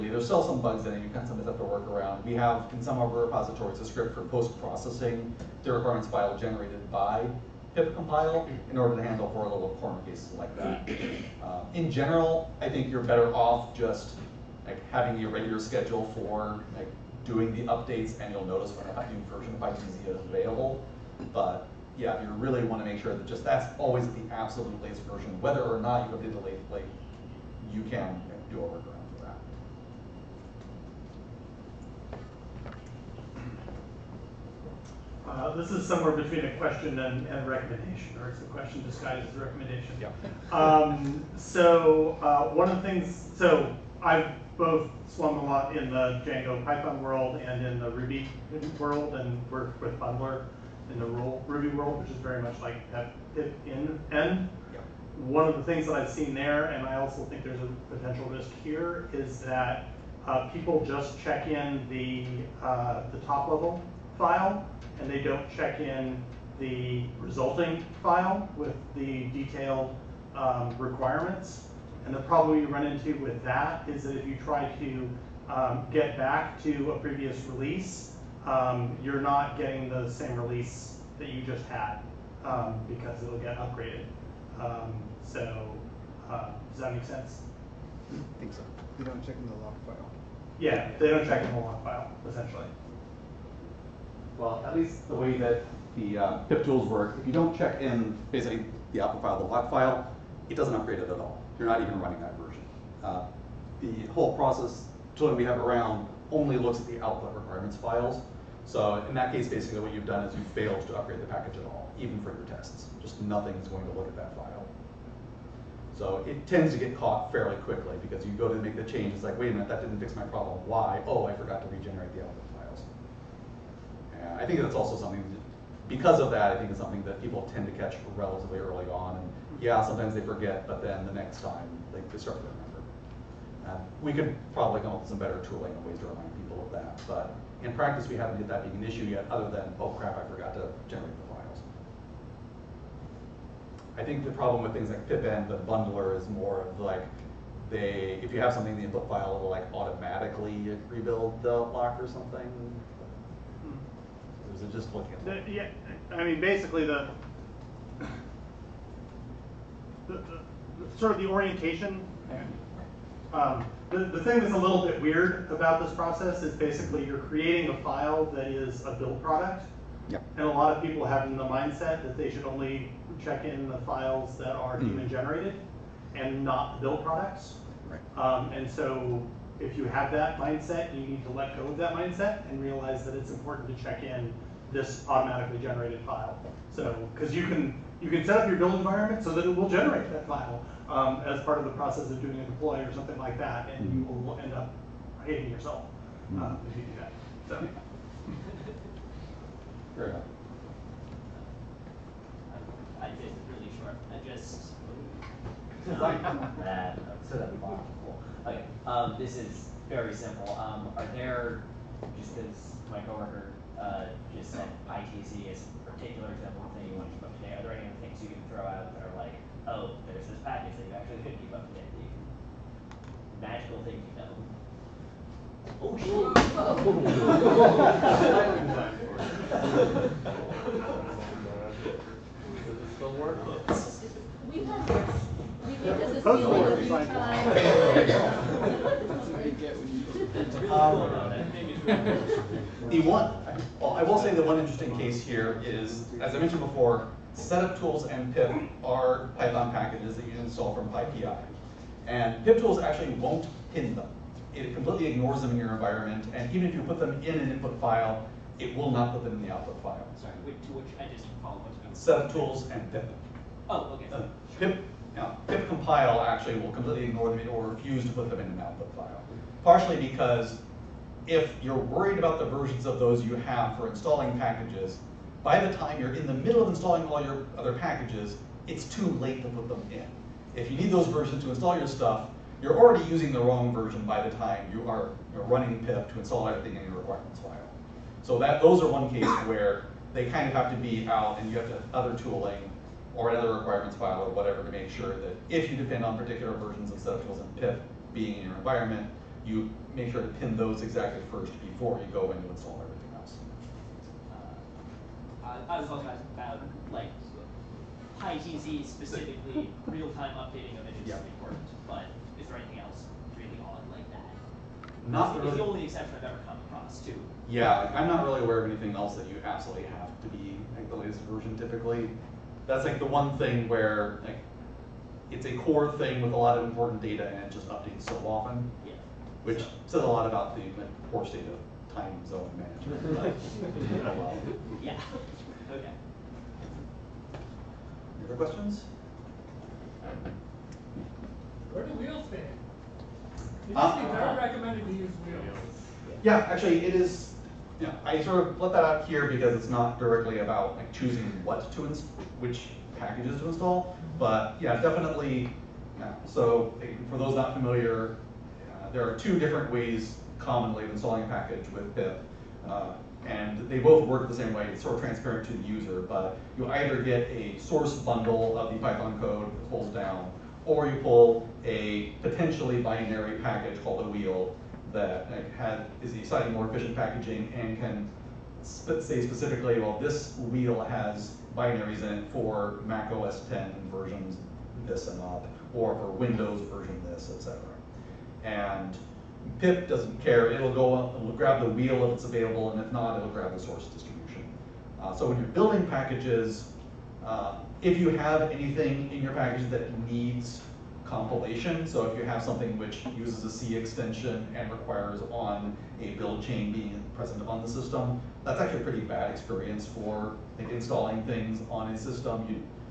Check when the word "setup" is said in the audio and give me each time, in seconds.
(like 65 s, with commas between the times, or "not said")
247 s, 261 s.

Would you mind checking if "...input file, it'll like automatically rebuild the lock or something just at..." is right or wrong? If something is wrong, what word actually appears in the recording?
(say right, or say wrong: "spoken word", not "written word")
right.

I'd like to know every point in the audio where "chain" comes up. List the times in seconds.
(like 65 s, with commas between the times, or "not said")
406 s.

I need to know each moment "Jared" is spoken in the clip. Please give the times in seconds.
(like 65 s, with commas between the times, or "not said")
not said.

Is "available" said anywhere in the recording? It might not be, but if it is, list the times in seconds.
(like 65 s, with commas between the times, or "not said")
20 s, 392 s.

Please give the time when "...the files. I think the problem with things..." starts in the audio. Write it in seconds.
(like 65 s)
141 s.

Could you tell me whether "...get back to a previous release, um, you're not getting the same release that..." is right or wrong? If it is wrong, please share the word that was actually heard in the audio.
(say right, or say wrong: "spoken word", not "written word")
right.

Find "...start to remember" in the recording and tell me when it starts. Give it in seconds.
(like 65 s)
132 s.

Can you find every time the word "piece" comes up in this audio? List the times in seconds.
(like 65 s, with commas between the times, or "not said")
not said.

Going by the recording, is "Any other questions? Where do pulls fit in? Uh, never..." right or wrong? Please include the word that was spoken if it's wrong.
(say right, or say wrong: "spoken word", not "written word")
wrong: "wheels", not "pulls".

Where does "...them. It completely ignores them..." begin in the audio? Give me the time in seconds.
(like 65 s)
253 s.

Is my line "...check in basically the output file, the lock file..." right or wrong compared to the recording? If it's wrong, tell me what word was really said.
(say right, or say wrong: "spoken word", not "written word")
right.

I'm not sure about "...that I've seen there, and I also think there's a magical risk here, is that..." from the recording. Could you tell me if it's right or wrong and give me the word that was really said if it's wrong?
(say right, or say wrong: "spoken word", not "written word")
wrong: "potential", not "magical".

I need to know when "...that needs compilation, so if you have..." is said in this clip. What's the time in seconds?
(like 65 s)
399 s.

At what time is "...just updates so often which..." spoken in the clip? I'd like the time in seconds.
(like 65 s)
327 s.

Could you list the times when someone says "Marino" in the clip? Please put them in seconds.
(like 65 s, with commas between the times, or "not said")
not said.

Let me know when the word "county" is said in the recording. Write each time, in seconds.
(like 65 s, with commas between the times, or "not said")
not said.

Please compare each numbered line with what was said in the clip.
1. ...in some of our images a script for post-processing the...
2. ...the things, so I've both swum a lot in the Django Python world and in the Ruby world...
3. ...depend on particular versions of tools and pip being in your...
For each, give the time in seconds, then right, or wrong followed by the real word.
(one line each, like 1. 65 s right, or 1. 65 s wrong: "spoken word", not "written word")
1. 2 s wrong: "repositories", not "images"
2. 42 s right
3. 295 s right.